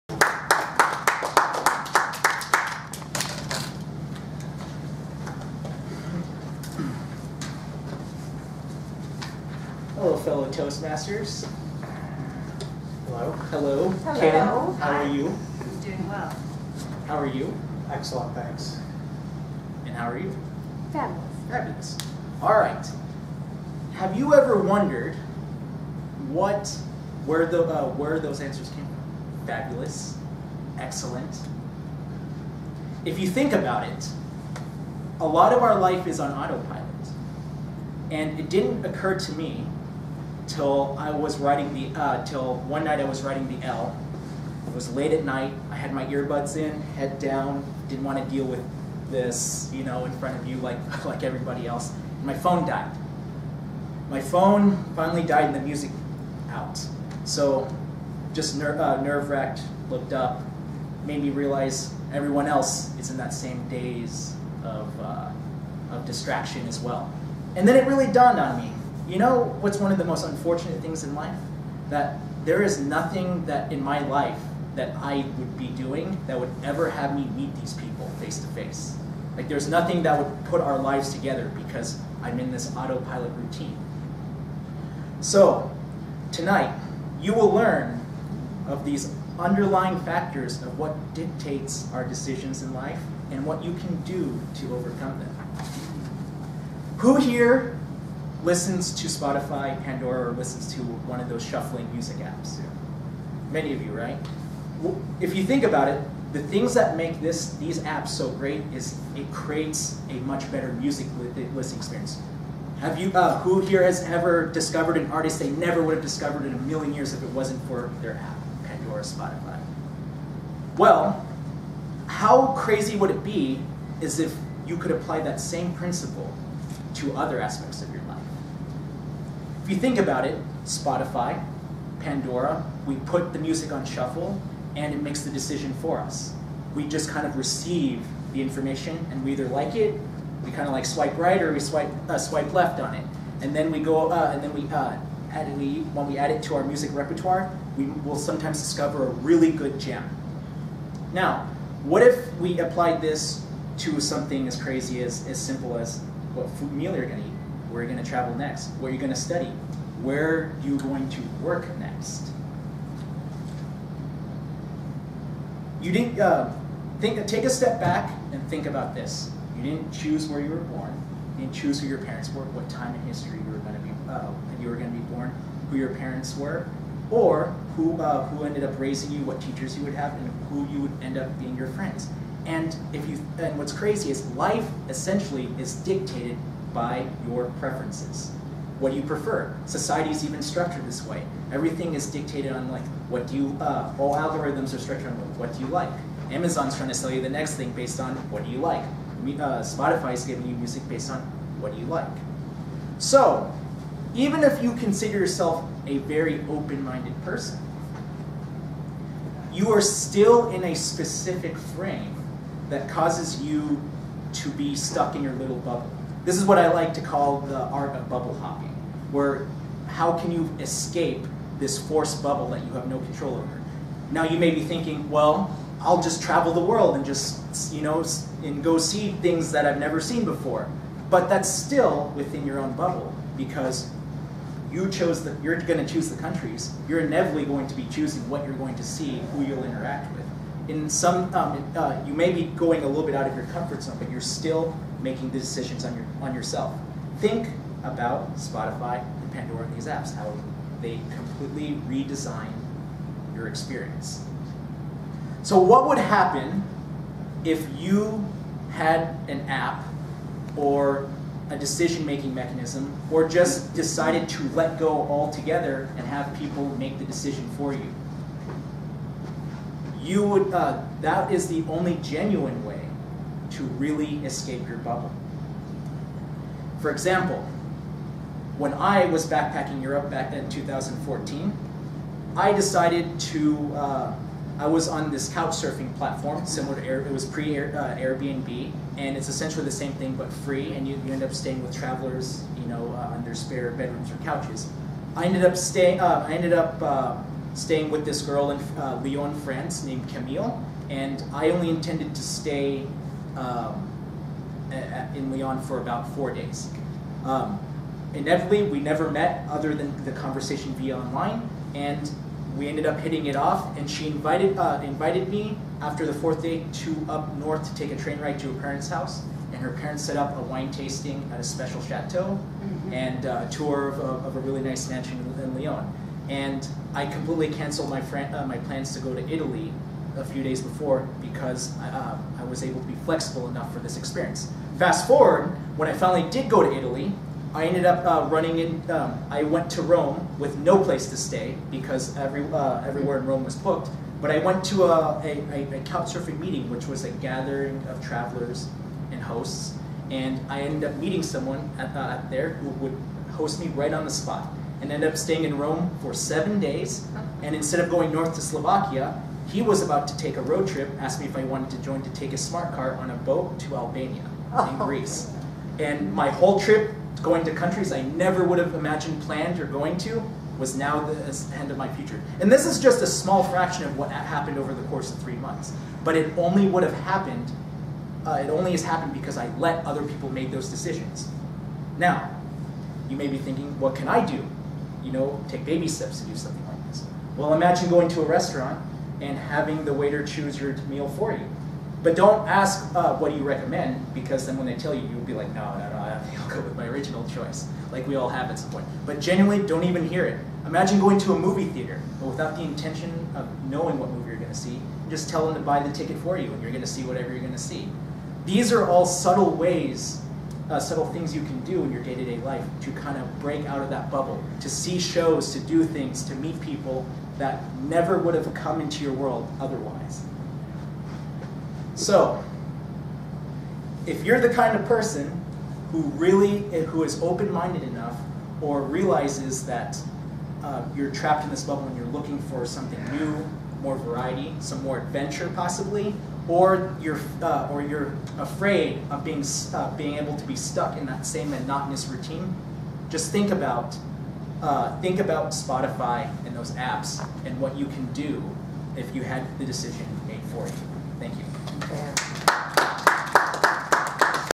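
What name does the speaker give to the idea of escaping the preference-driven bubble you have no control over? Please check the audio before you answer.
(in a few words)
bubble hopping.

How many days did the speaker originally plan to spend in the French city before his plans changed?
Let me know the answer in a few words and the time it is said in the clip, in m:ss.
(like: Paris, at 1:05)
4, at 5:06.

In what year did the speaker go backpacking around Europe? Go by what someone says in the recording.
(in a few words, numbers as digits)
2014.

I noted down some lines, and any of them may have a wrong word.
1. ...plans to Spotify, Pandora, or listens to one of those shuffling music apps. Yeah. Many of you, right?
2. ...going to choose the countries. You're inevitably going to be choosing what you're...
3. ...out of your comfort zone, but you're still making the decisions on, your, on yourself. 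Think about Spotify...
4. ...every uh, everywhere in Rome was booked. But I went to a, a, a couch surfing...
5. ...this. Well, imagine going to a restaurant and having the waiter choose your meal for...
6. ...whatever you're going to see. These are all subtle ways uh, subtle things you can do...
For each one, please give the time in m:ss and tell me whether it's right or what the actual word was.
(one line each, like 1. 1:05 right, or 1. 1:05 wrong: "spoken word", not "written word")
1. 1:38 wrong: "listens", not "plans"
2. 3:55 right
3. 4:03 right
4. 5:42 right
5. 6:26 right
6. 6:47 right.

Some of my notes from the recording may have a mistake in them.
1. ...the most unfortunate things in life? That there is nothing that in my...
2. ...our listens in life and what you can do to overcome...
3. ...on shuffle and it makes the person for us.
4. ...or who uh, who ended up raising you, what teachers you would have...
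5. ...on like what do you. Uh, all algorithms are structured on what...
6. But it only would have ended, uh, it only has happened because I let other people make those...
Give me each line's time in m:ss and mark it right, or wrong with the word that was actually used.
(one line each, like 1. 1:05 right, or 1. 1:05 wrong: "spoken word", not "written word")
1. 1:09 right
2. 1:31 wrong: "decisions", not "listens"
3. 2:13 wrong: "decision", not "person"
4. 2:57 right
5. 3:12 right
6. 6:16 wrong: "happened", not "ended".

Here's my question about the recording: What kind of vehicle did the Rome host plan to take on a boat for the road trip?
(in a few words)
smart car.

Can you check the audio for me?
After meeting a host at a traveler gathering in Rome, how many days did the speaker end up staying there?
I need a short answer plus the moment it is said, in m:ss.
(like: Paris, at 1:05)
7, at 5:56.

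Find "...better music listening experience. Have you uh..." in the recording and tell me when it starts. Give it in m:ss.
1:50.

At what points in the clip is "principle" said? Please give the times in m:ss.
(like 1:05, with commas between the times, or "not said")
2:05.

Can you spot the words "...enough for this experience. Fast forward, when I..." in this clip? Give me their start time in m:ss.
5:33.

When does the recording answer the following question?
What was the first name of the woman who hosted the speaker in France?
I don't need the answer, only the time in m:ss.
5:00.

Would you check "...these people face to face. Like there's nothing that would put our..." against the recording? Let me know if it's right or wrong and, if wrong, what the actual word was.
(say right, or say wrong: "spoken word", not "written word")
right.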